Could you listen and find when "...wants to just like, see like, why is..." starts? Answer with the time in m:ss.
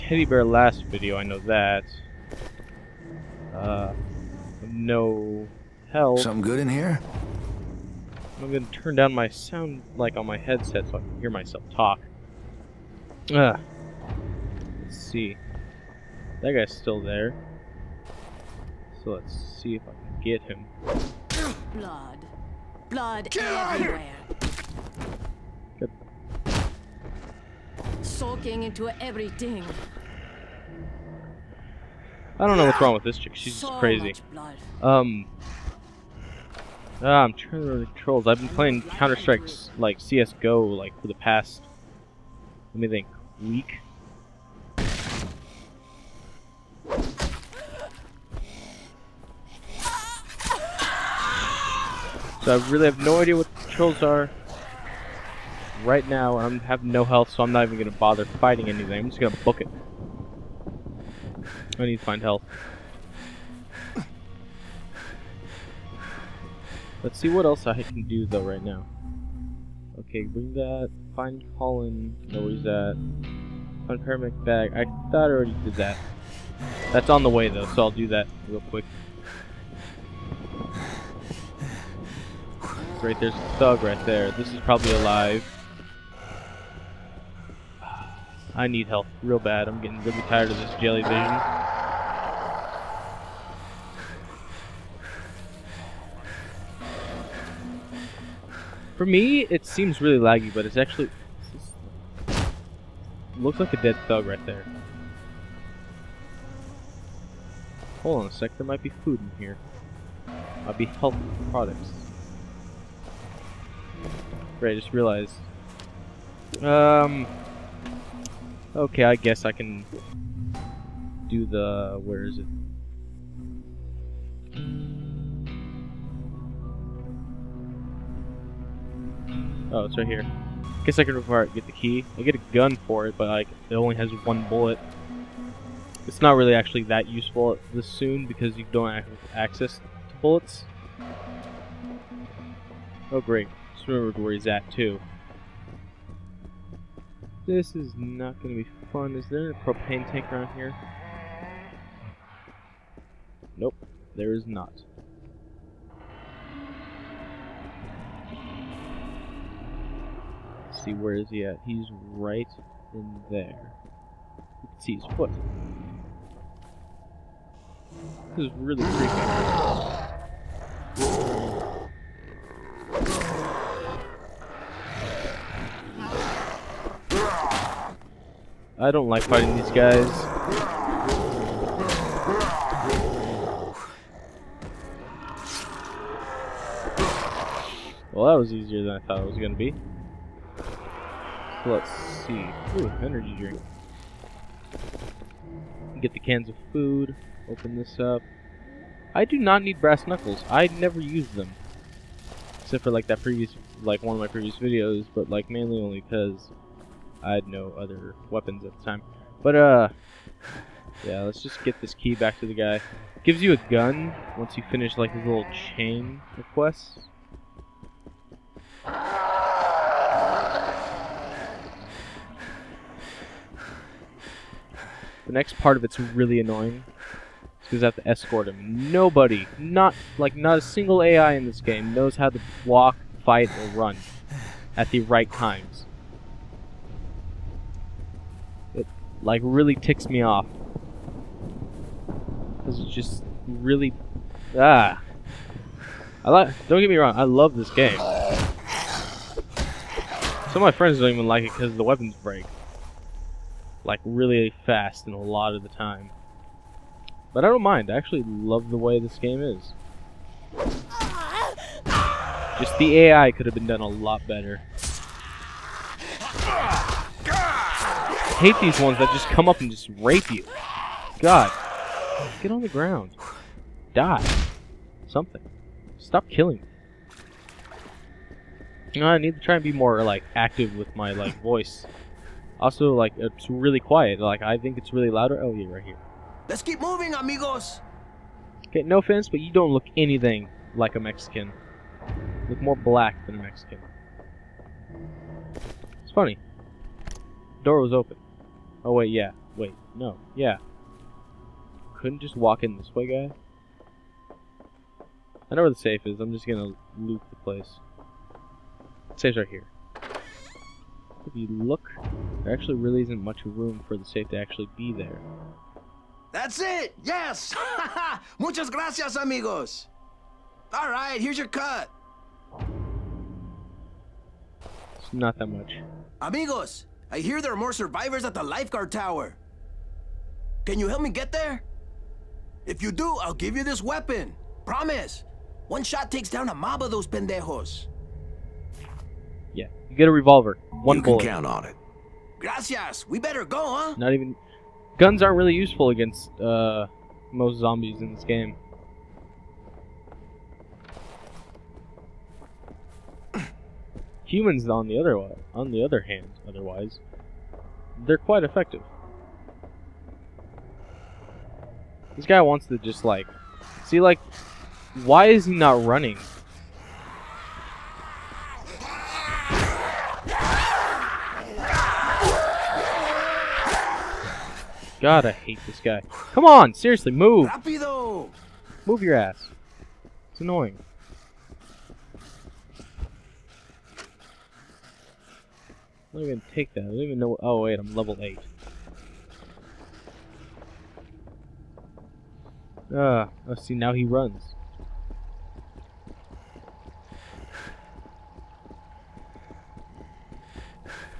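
6:02.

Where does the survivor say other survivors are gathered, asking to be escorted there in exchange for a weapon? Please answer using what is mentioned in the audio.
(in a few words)
Lifeguard tower.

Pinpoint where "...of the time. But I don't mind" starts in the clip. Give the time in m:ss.
4:15.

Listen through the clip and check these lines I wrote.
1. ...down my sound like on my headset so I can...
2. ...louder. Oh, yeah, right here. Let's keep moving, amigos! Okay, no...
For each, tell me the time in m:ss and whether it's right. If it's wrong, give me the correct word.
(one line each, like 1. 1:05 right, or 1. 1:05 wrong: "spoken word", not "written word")
1. 0:08 right
2. 4:45 right.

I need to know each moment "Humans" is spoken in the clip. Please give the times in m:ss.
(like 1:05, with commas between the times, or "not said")
5:54.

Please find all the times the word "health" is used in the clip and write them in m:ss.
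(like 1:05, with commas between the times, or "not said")
0:05, 0:57, 1:02, 1:50.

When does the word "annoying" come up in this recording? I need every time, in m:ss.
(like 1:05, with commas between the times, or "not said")
3:46, 6:20.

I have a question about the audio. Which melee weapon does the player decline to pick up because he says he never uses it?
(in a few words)
Brass knuckles.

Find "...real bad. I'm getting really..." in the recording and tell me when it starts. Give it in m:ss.
1:29.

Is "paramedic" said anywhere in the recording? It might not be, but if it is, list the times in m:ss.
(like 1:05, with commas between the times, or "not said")
1:14.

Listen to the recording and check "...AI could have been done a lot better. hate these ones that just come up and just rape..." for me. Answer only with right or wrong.
right.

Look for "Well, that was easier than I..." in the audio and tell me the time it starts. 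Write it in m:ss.
3:08.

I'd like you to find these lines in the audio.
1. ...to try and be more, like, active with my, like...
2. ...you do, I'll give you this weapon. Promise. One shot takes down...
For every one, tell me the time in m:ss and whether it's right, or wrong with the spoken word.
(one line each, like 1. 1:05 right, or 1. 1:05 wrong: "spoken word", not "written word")
1. 4:39 right
2. 5:32 right.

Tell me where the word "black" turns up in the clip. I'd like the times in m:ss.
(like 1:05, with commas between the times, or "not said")
4:52.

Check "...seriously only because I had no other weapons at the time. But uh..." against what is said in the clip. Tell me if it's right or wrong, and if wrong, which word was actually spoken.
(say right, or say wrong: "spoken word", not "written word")
wrong: "mainly", not "seriously".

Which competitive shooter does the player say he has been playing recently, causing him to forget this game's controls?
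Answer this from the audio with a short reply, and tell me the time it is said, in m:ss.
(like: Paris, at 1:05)
CS:GO, at 0:39.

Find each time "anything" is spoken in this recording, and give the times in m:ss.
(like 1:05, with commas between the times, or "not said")
0:58, 4:49.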